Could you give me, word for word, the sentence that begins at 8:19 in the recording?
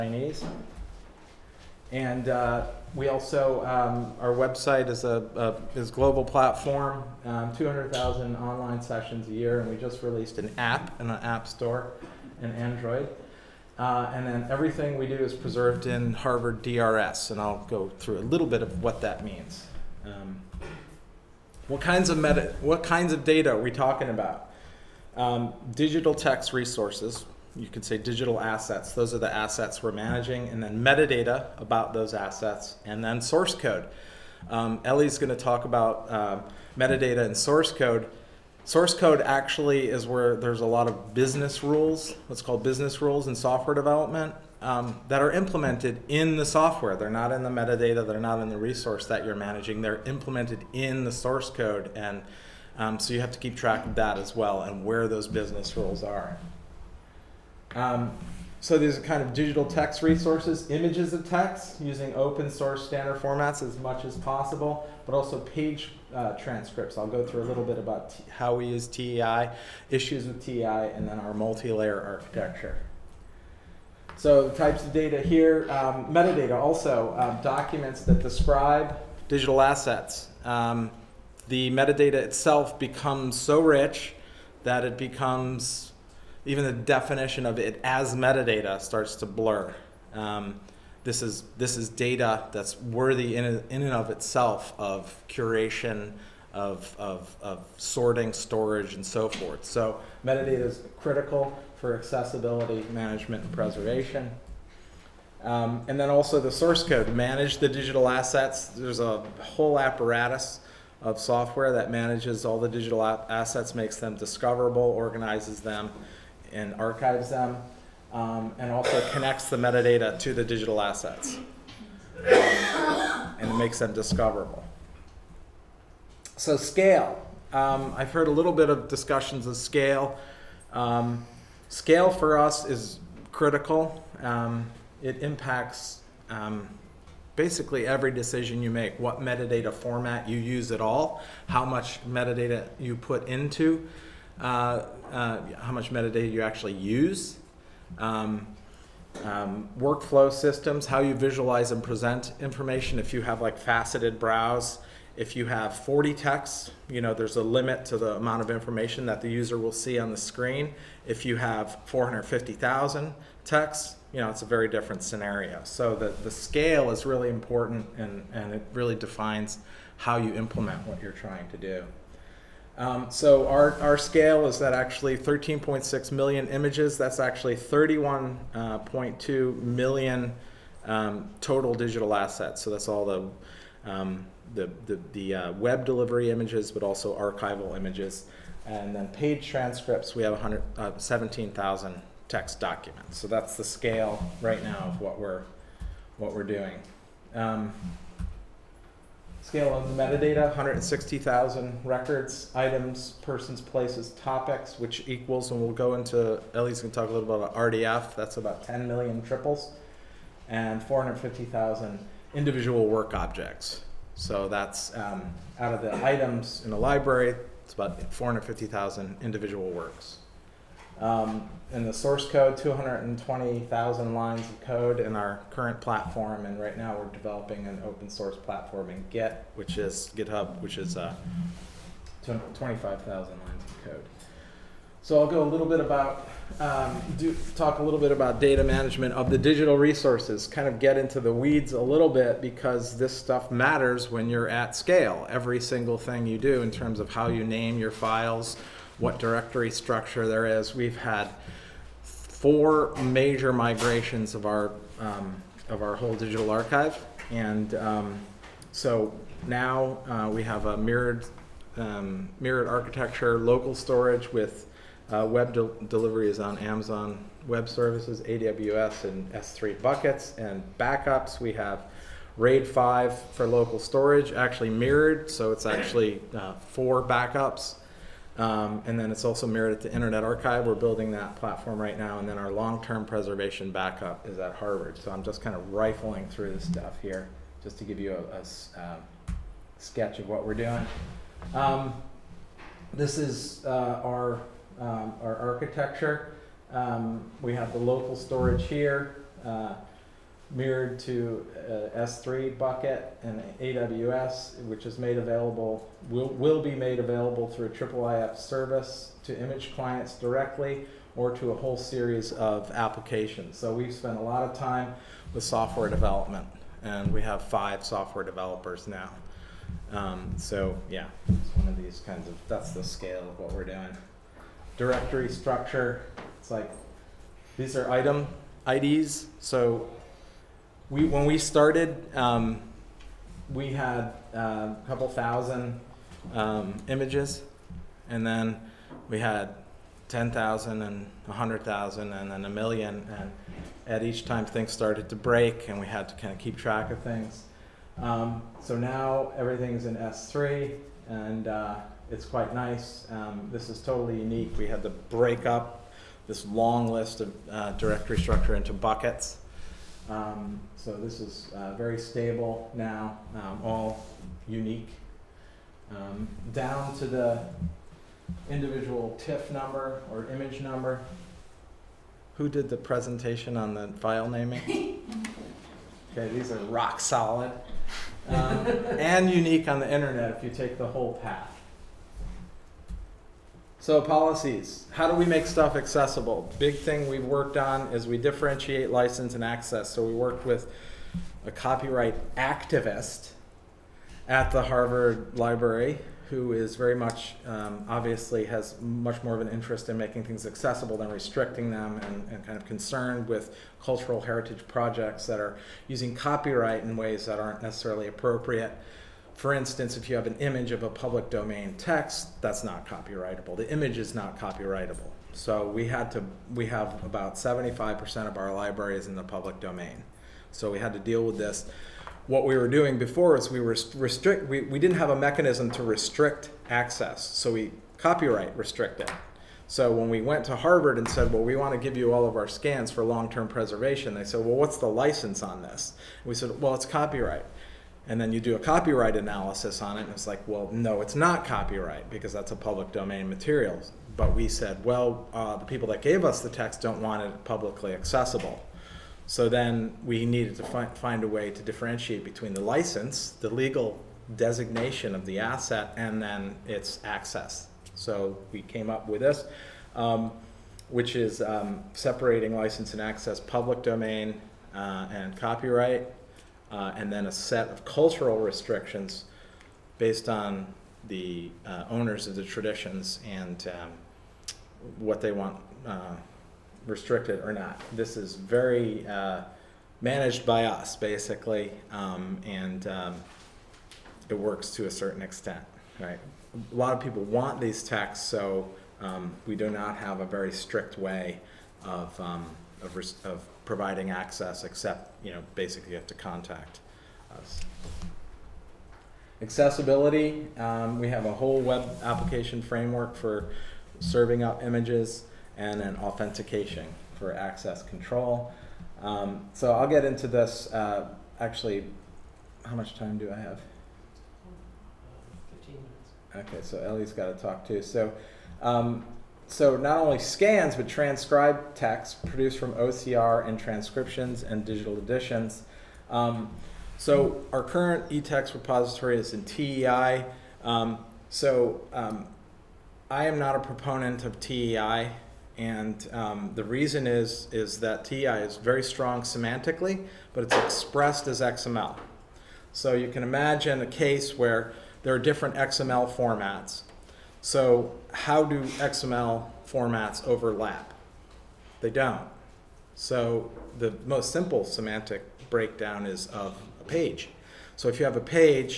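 Accessibility, um, we have a whole web application framework for serving up images and an authentication for access control.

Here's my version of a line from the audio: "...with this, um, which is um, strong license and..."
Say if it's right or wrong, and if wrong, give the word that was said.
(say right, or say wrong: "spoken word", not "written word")
wrong: "separating", not "strong".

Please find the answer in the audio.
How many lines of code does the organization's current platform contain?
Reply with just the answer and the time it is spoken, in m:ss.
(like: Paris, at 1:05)
220,000, at 3:42.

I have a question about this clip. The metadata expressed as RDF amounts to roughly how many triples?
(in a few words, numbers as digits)
10 million.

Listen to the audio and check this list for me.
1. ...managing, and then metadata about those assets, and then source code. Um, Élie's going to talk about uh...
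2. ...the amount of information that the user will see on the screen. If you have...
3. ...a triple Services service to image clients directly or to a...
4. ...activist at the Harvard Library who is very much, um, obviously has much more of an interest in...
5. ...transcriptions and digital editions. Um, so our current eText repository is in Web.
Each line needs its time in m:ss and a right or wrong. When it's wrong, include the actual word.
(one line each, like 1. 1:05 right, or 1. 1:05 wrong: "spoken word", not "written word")
1. 0:29 right
2. 2:37 right
3. 5:07 wrong: "IIIF", not "Services"
4. 6:32 right
5. 8:43 wrong: "TEI", not "Web".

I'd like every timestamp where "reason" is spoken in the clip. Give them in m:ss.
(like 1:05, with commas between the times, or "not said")
8:56.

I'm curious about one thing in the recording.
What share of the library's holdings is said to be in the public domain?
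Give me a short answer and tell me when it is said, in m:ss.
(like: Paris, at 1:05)
75%, at 6:57.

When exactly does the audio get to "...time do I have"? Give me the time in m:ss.
8:32.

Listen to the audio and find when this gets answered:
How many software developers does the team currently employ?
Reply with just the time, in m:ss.
5:17.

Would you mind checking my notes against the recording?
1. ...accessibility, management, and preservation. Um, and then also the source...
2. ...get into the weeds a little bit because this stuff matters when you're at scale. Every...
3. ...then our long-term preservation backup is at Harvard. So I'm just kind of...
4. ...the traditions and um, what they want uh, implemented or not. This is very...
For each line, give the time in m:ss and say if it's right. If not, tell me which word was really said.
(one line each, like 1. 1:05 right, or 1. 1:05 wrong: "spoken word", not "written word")
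1. 1:41 right
2. 4:00 right
3. 4:42 right
4. 7:52 wrong: "restricted", not "implemented".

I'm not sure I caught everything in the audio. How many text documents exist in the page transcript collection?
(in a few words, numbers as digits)
17,000.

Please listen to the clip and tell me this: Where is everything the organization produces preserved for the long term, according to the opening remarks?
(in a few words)
Harvard DRS.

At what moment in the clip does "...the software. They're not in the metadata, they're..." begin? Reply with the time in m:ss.
0:46.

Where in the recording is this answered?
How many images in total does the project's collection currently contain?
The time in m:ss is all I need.
2:55.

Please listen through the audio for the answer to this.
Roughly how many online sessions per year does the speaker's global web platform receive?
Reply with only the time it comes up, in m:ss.
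0:07.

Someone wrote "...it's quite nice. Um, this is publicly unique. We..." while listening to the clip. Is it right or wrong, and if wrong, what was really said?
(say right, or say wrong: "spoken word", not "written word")
wrong: "totally", not "publicly".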